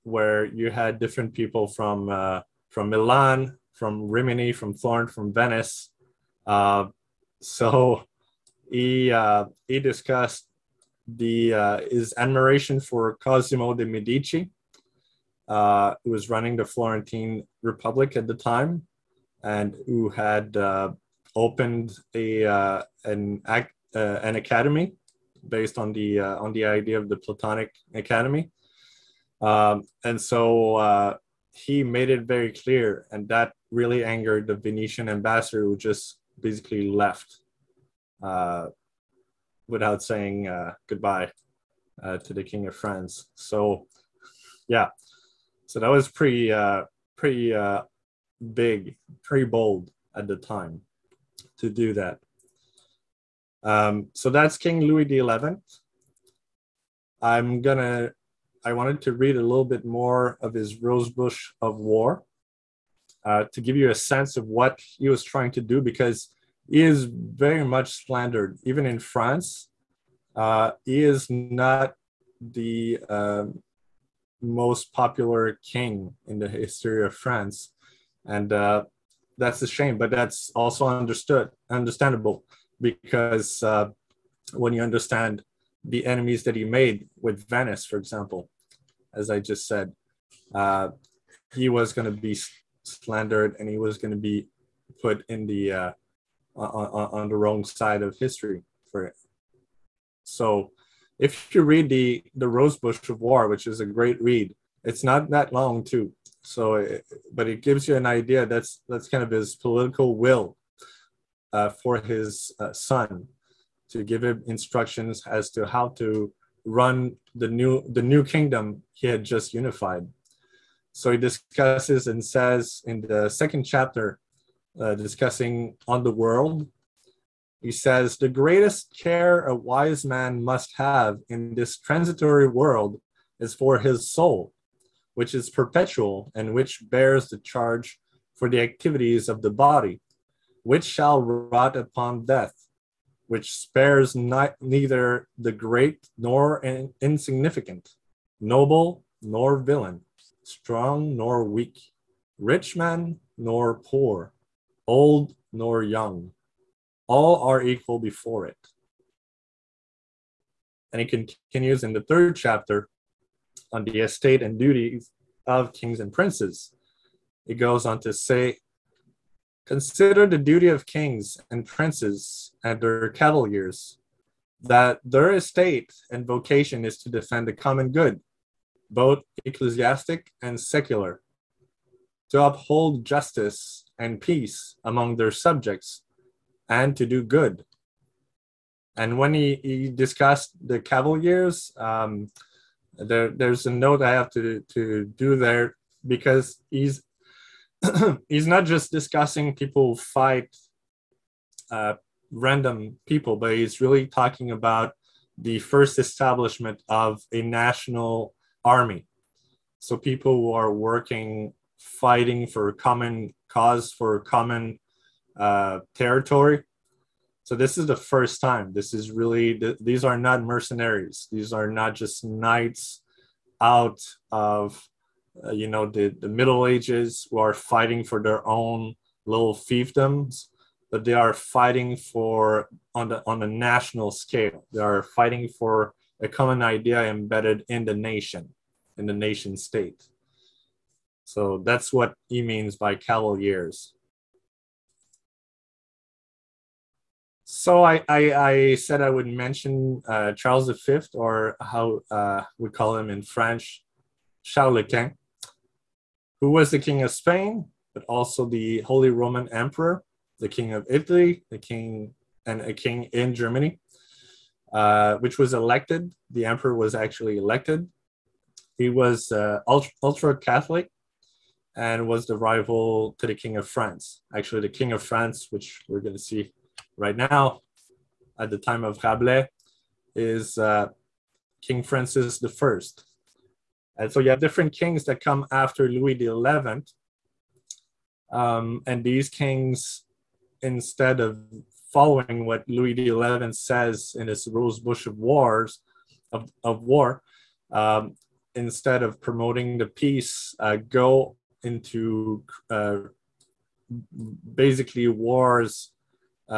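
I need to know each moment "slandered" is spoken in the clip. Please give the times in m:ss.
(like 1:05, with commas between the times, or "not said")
1:08, 1:32.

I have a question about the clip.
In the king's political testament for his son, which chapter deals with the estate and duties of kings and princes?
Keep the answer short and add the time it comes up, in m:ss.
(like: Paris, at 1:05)
third, at 2:42.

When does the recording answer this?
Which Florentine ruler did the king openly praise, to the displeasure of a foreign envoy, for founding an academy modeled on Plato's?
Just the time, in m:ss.
0:13.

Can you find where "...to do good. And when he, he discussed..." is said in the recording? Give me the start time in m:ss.
3:06.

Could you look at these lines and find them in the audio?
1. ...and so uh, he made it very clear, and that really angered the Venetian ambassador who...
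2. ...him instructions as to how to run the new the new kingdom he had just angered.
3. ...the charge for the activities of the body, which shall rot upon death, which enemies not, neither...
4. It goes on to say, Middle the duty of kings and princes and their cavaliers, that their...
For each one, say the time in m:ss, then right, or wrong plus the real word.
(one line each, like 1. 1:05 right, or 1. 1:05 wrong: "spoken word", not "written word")
1. 0:30 right
2. 1:54 wrong: "unified", not "angered"
3. 2:17 wrong: "spares", not "enemies"
4. 2:47 wrong: "Consider", not "Middle".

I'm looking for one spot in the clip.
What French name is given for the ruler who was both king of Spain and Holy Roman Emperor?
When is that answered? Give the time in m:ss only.
4:14.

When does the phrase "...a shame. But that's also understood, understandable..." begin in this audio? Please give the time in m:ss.
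1:19.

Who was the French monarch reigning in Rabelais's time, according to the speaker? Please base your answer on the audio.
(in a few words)
Francis I.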